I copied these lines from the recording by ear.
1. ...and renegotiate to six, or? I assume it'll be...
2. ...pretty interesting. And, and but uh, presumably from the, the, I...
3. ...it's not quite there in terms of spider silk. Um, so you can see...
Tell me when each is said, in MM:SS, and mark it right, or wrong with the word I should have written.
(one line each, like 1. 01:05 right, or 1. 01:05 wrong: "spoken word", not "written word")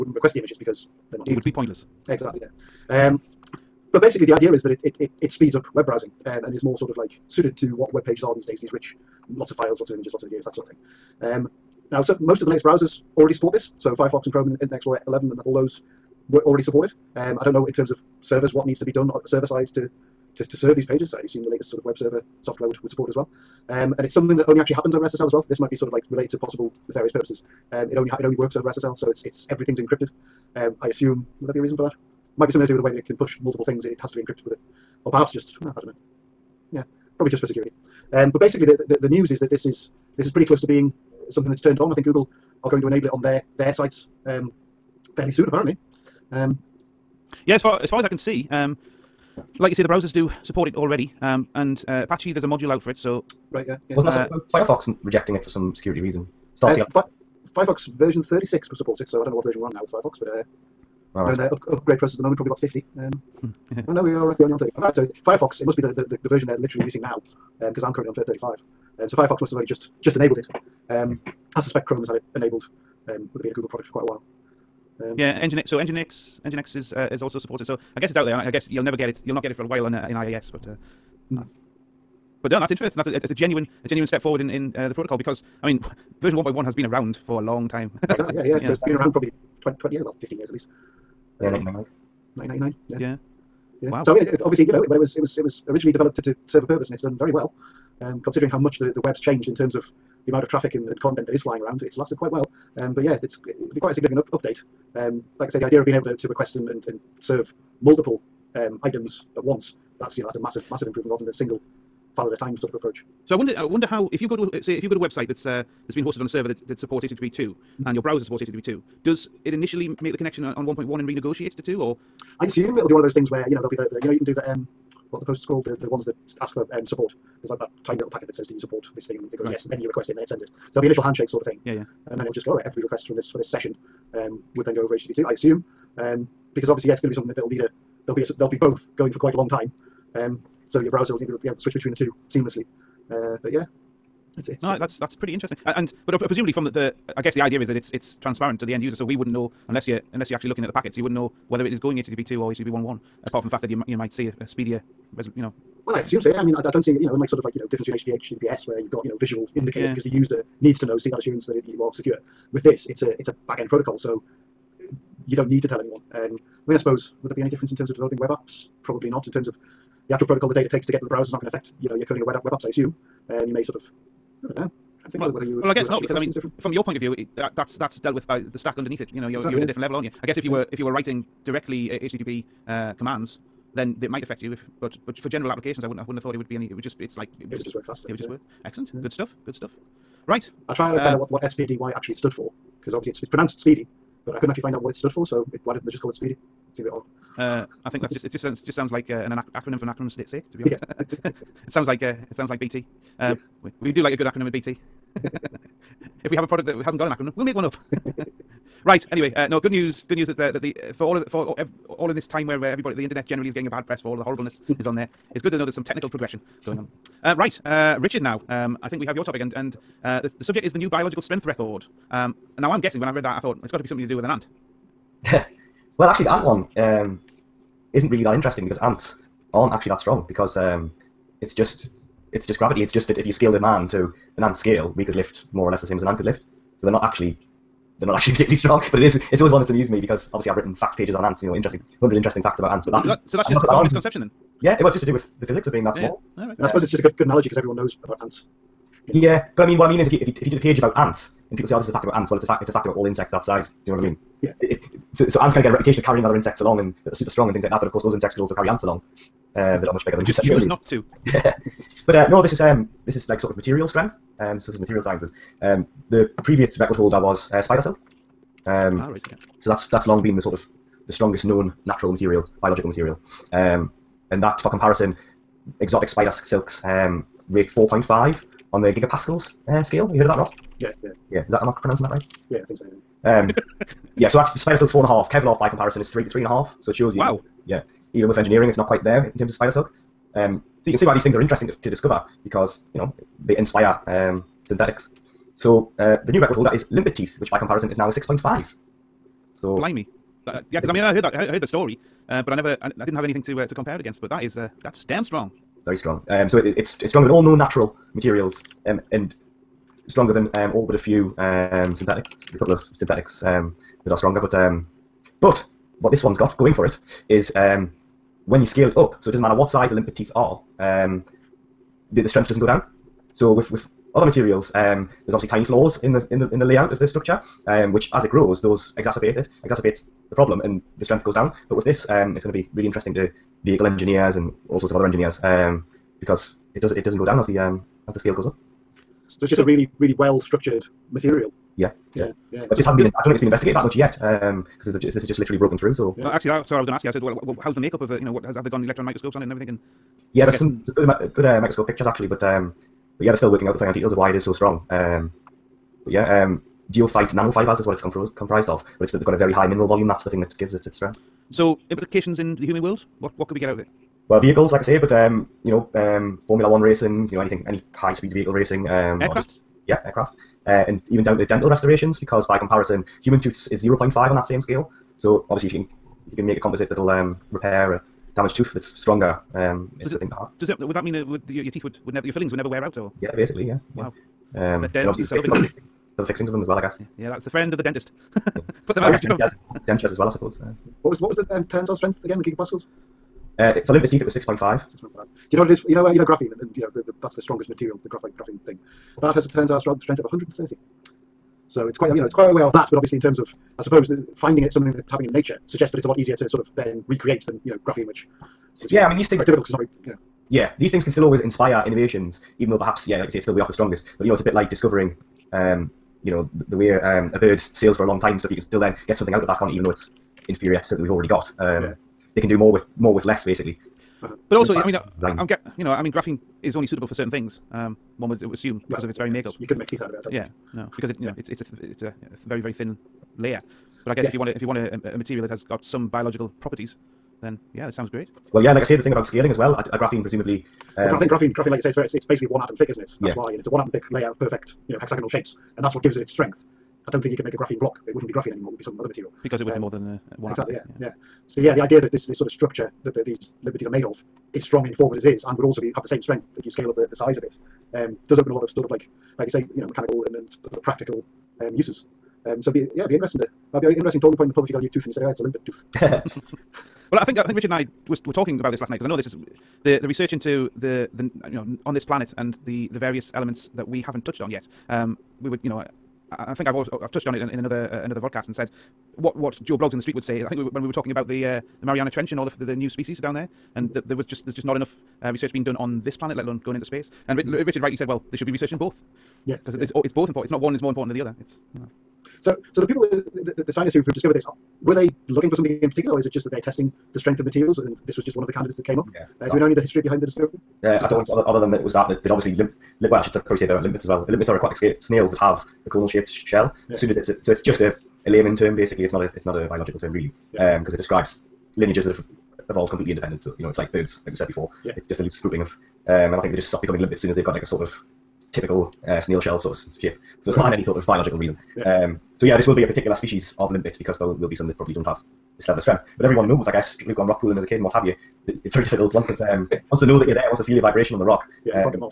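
1. 02:01 wrong: "two", not "six"
2. 02:25 right
3. 04:48 right.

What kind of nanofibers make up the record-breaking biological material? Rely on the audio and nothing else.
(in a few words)
Goethite.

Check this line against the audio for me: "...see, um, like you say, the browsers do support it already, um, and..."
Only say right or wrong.
right.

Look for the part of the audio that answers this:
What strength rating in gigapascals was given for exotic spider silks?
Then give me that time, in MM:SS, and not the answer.
04:37.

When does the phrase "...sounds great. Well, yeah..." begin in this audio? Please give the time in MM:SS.
07:17.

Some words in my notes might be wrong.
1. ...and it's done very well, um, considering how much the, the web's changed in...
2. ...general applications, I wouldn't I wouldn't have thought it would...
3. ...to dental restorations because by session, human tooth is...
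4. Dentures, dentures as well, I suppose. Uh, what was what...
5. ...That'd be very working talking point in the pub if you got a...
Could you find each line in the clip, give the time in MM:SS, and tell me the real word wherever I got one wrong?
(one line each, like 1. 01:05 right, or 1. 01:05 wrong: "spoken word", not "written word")
1. 01:36 right
2. 03:05 right
3. 06:11 wrong: "comparison", not "session"
4. 06:29 right
5. 07:43 wrong: "interesting", not "working".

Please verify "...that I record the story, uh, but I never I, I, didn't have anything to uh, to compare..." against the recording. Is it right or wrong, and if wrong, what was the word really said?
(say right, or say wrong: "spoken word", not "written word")
wrong: "heard", not "record".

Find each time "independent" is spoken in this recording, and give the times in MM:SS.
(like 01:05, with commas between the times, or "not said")
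08:33.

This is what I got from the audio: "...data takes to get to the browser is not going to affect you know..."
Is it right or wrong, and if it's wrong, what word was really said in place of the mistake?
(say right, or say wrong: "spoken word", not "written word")
right.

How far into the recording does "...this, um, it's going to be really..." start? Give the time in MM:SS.
05:31.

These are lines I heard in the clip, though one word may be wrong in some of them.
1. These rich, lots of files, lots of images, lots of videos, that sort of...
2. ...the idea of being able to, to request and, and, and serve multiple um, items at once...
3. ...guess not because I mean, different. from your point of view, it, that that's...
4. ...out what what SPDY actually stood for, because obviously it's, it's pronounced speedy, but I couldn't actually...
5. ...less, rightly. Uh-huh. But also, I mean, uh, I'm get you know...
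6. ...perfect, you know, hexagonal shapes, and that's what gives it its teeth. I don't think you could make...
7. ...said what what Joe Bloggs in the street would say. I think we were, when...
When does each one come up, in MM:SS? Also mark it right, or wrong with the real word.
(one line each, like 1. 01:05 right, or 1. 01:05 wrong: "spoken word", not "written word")
1. 00:08 right
2. 01:45 right
3. 02:55 right
4. 03:11 right
5. 07:03 wrong: "basically", not "rightly"
6. 07:24 wrong: "strength", not "teeth"
7. 07:58 right.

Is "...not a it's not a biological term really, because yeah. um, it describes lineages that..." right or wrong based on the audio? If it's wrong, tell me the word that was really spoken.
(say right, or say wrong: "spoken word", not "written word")
right.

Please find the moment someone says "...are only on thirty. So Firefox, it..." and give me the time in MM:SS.
01:04.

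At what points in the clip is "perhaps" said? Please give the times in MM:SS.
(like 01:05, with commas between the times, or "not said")
00:35, 06:52.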